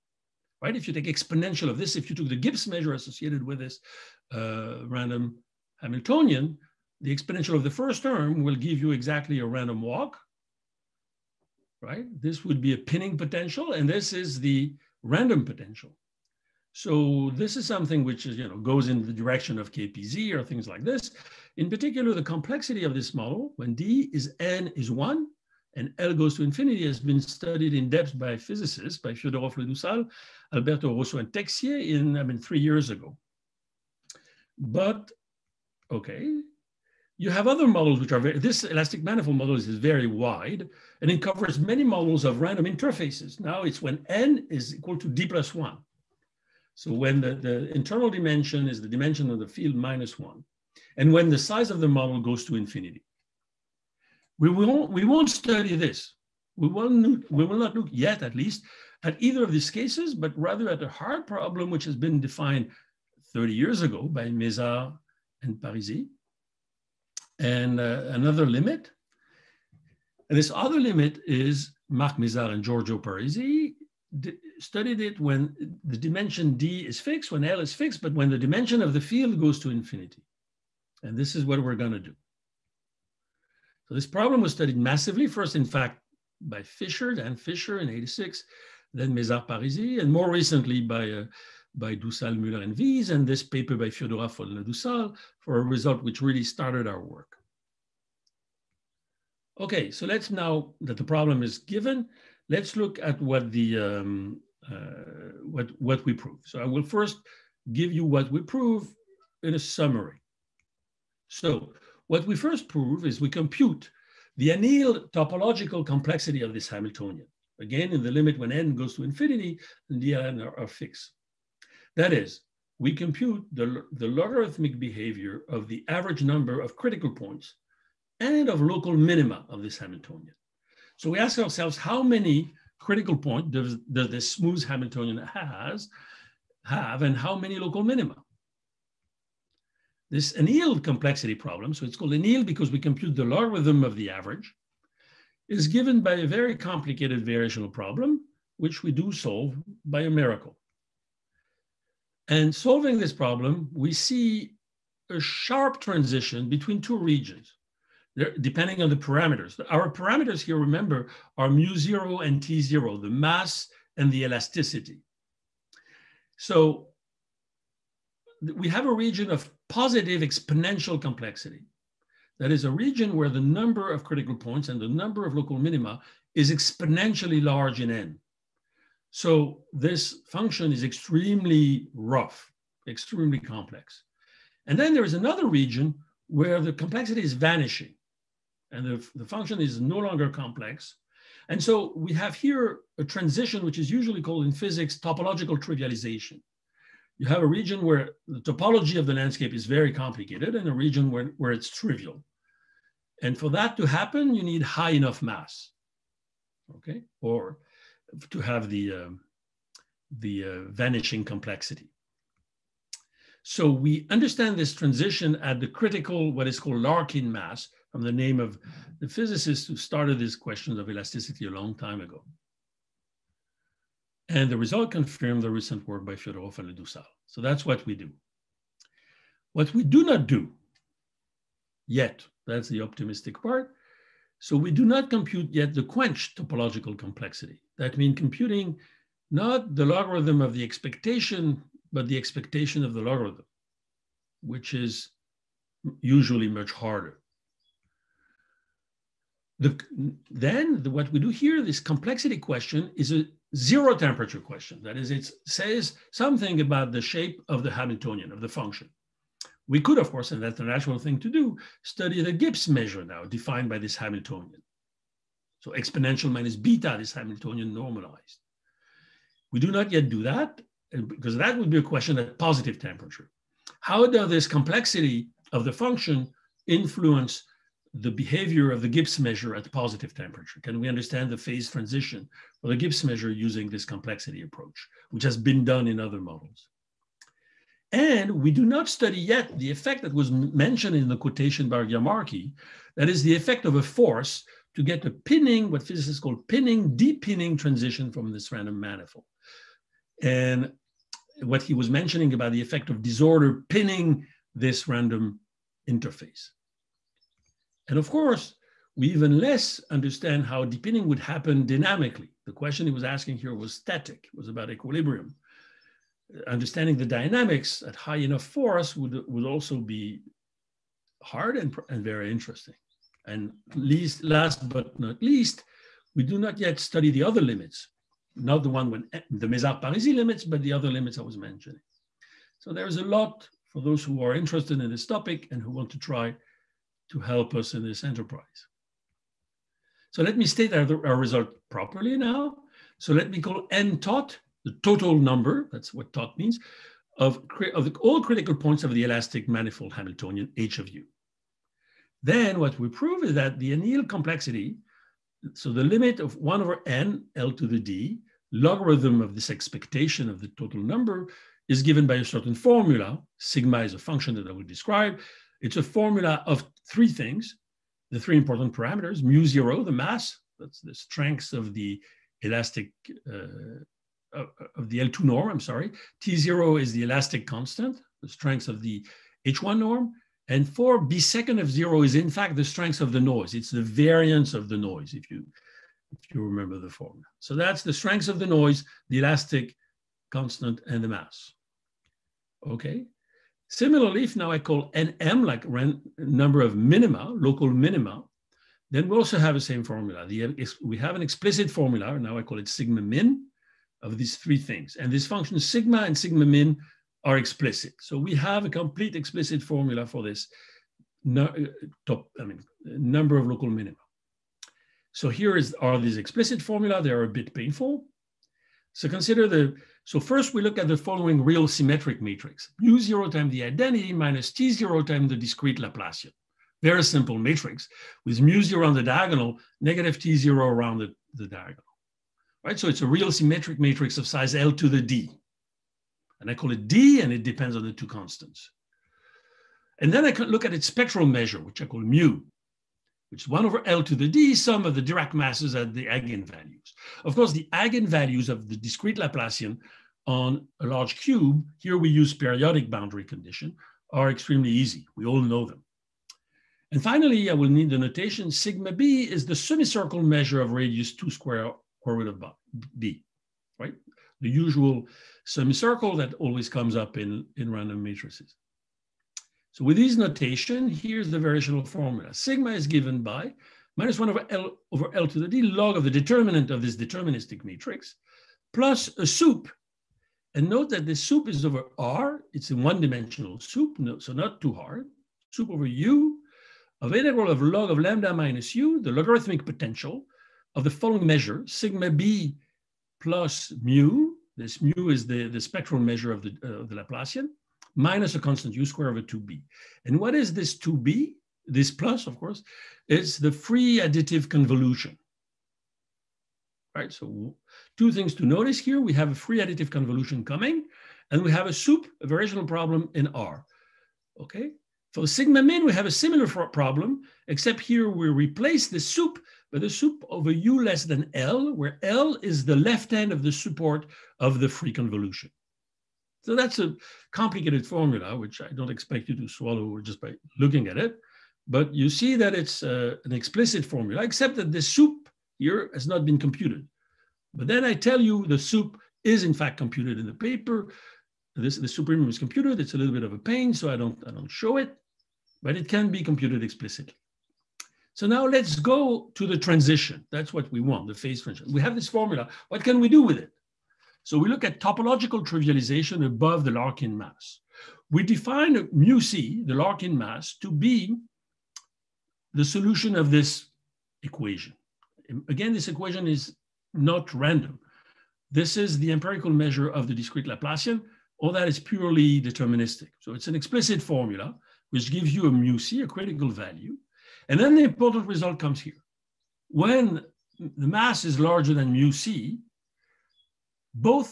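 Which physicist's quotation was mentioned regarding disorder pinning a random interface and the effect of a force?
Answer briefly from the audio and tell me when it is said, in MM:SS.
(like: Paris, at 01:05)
Giamarchi, at 04:51.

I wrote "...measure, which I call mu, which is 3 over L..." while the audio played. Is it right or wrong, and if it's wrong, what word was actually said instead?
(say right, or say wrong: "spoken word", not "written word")
wrong: "1", not "3".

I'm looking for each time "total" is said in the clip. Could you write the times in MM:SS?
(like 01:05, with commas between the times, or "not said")
05:44, 06:00.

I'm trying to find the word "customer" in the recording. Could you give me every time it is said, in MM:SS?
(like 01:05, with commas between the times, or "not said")
not said.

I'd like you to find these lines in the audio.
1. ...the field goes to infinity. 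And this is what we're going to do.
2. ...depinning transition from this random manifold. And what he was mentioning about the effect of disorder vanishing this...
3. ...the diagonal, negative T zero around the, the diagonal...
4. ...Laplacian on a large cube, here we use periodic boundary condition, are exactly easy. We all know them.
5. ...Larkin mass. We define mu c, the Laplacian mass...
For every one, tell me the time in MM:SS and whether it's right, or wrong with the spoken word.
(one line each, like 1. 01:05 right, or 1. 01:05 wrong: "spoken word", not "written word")
1. 01:18 right
2. 04:56 wrong: "pinning", not "vanishing"
3. 07:08 right
4. 07:29 wrong: "extremely", not "exactly"
5. 09:16 wrong: "Larkin", not "Laplacian".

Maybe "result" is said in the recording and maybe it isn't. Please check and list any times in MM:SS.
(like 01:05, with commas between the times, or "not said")
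01:35, 03:44, 05:41, 09:38.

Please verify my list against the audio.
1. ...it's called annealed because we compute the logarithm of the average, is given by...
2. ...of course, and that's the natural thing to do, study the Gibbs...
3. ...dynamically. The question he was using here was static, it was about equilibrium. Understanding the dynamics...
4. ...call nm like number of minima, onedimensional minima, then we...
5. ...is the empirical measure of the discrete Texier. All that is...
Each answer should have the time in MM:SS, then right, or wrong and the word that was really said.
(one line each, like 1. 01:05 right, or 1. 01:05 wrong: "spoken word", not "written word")
1. 02:21 right
2. 04:19 right
3. 05:11 wrong: "asking", not "using"
4. 06:34 wrong: "local", not "onedimensional"
5. 09:28 wrong: "Laplacian", not "Texier".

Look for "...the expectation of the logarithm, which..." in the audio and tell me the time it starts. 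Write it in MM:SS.
04:02.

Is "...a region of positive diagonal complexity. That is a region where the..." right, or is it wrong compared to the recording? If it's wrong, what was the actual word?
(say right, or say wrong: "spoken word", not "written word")
wrong: "exponential", not "diagonal".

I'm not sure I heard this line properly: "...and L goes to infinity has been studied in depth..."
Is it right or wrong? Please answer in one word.
right.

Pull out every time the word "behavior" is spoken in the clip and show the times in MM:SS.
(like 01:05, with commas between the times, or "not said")
02:04, 04:38.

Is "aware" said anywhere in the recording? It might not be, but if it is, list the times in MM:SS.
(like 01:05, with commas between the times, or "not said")
not said.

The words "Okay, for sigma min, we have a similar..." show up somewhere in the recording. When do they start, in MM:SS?
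08:34.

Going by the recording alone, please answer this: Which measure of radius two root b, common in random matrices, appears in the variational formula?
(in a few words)
semicircle measure.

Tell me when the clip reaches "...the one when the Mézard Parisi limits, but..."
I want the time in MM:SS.
05:28.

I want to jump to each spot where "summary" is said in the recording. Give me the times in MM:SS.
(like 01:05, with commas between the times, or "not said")
01:49.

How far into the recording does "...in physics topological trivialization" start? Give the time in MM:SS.
03:14.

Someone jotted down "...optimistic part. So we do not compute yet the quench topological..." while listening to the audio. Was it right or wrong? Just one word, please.
right.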